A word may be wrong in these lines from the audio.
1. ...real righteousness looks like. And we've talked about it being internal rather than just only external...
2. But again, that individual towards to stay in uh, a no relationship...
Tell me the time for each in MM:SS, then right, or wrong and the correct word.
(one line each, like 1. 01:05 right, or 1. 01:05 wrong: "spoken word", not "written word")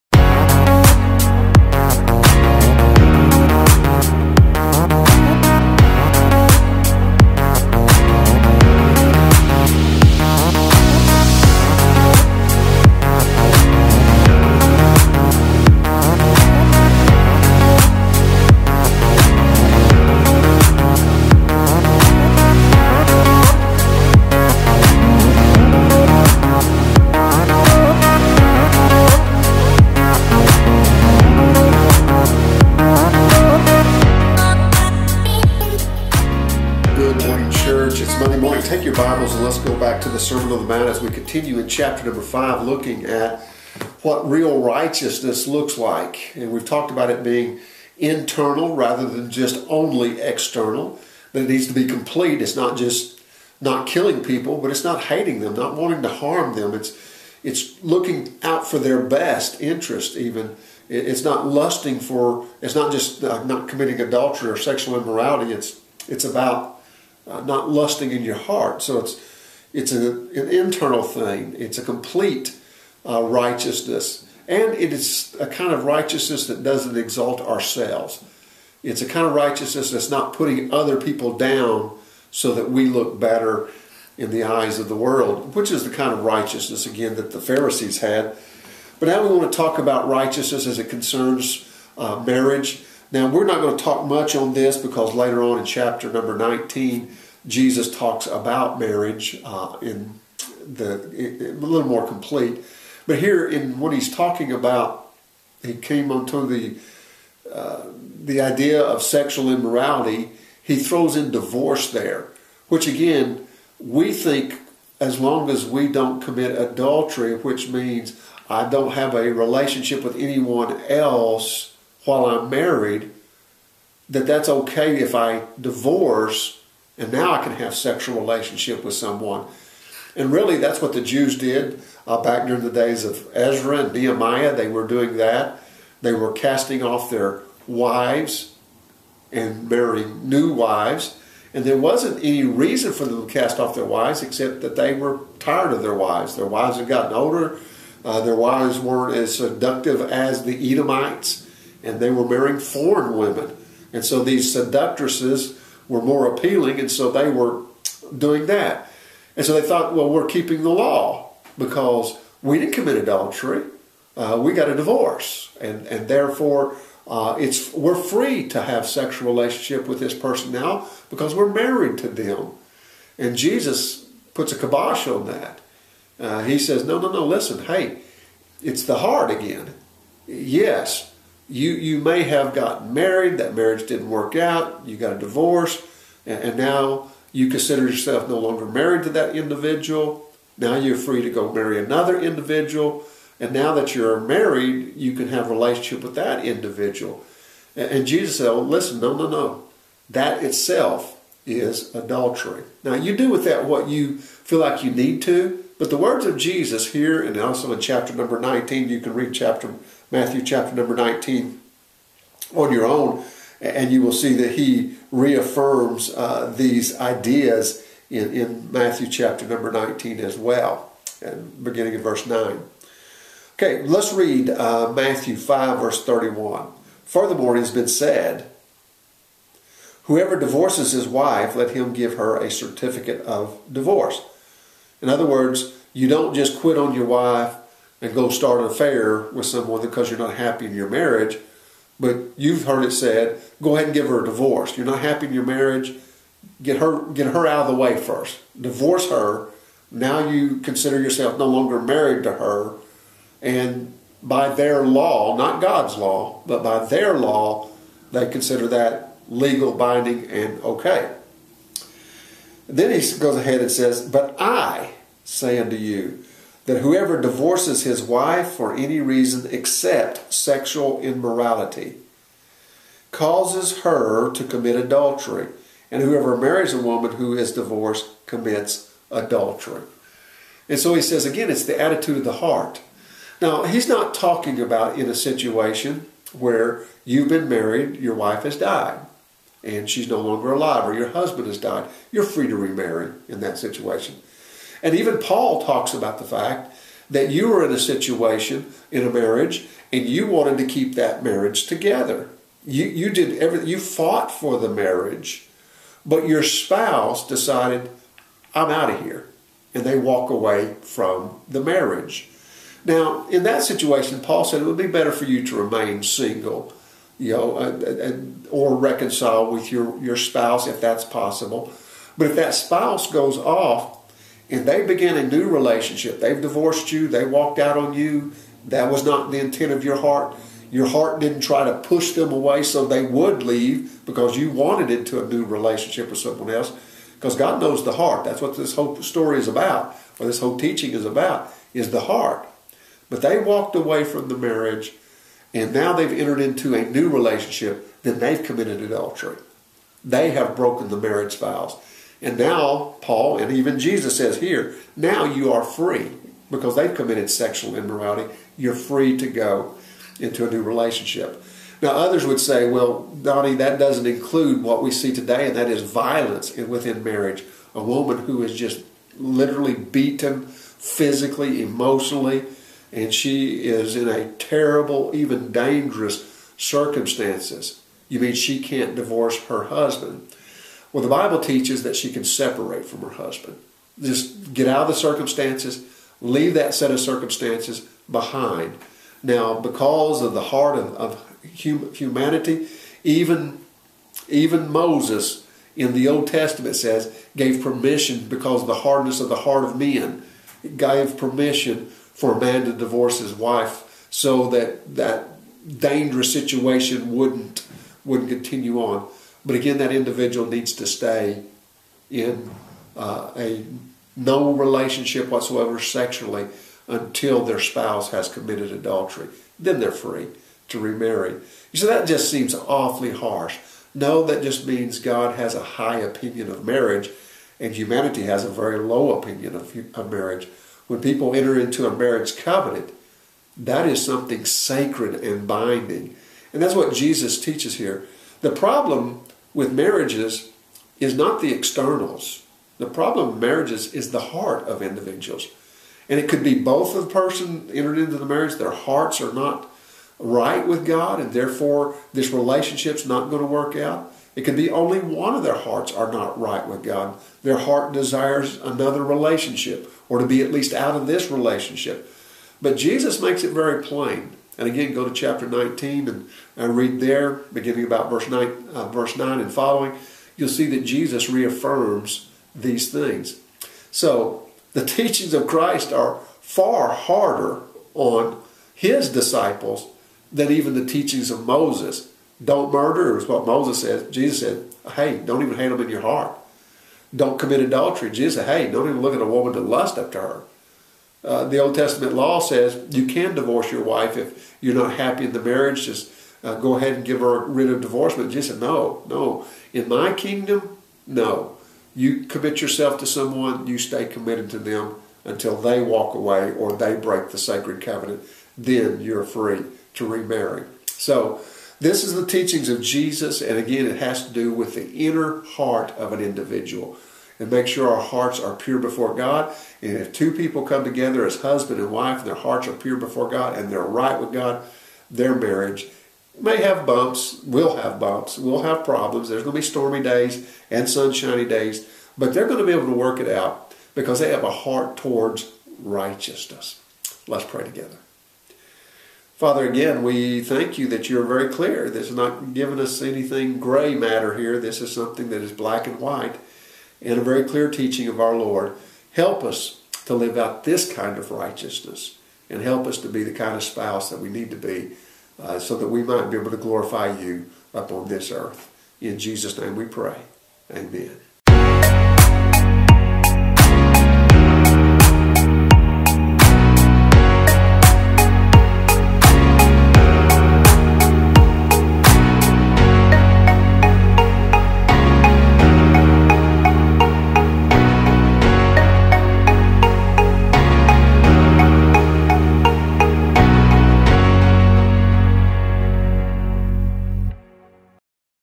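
1. 00:44 right
2. 06:49 wrong: "needs", not "towards".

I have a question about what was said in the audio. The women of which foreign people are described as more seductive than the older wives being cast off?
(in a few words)
Edomites.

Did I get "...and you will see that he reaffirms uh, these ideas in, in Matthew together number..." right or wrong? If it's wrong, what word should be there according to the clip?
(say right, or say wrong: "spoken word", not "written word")
wrong: "chapter", not "together".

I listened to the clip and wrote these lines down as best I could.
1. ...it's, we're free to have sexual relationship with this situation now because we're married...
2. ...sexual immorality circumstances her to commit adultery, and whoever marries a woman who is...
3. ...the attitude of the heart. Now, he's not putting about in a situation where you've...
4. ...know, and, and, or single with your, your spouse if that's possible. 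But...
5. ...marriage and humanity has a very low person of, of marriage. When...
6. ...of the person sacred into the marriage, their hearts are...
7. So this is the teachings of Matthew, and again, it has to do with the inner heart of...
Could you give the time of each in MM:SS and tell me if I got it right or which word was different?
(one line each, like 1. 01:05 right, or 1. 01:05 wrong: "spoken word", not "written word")
1. 02:47 wrong: "person", not "situation"
2. 04:30 wrong: "causes", not "circumstances"
3. 04:41 wrong: "talking", not "putting"
4. 05:17 wrong: "reconcile", not "single"
5. 07:06 wrong: "opinion", not "person"
6. 07:26 wrong: "entered", not "sacred"
7. 08:30 wrong: "Jesus", not "Matthew".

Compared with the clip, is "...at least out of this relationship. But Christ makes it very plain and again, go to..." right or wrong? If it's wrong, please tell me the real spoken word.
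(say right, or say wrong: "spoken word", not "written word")
wrong: "Jesus", not "Christ".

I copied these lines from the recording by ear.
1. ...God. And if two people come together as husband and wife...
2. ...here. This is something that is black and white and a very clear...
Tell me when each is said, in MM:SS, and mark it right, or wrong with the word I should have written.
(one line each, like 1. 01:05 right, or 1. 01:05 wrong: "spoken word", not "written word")
1. 08:39 right
2. 09:04 right.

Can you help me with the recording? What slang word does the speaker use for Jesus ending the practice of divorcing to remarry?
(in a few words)
kibosh.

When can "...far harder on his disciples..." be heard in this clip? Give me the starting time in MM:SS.
07:56.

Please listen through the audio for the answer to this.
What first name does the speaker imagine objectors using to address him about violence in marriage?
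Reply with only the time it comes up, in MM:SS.
06:03.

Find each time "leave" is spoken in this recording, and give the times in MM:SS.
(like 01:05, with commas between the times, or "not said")
05:33, 06:26.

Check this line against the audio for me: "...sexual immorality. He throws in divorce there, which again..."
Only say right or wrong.
right.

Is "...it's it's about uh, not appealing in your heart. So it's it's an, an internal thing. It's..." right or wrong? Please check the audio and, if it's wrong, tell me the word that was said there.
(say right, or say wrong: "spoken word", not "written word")
wrong: "lusting", not "appealing".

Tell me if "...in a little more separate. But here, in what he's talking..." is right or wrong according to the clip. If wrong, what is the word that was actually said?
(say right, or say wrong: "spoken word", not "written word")
wrong: "complete", not "separate".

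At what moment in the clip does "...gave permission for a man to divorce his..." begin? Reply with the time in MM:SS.
06:40.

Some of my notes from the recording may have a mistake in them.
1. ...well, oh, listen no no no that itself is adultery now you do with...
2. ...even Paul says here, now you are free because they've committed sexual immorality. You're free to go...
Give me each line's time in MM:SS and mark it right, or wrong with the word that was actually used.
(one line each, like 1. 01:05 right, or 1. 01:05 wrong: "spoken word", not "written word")
1. 03:18 right
2. 05:53 wrong: "Jesus", not "Paul".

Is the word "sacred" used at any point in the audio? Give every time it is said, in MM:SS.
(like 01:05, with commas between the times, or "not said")
07:14, 08:27.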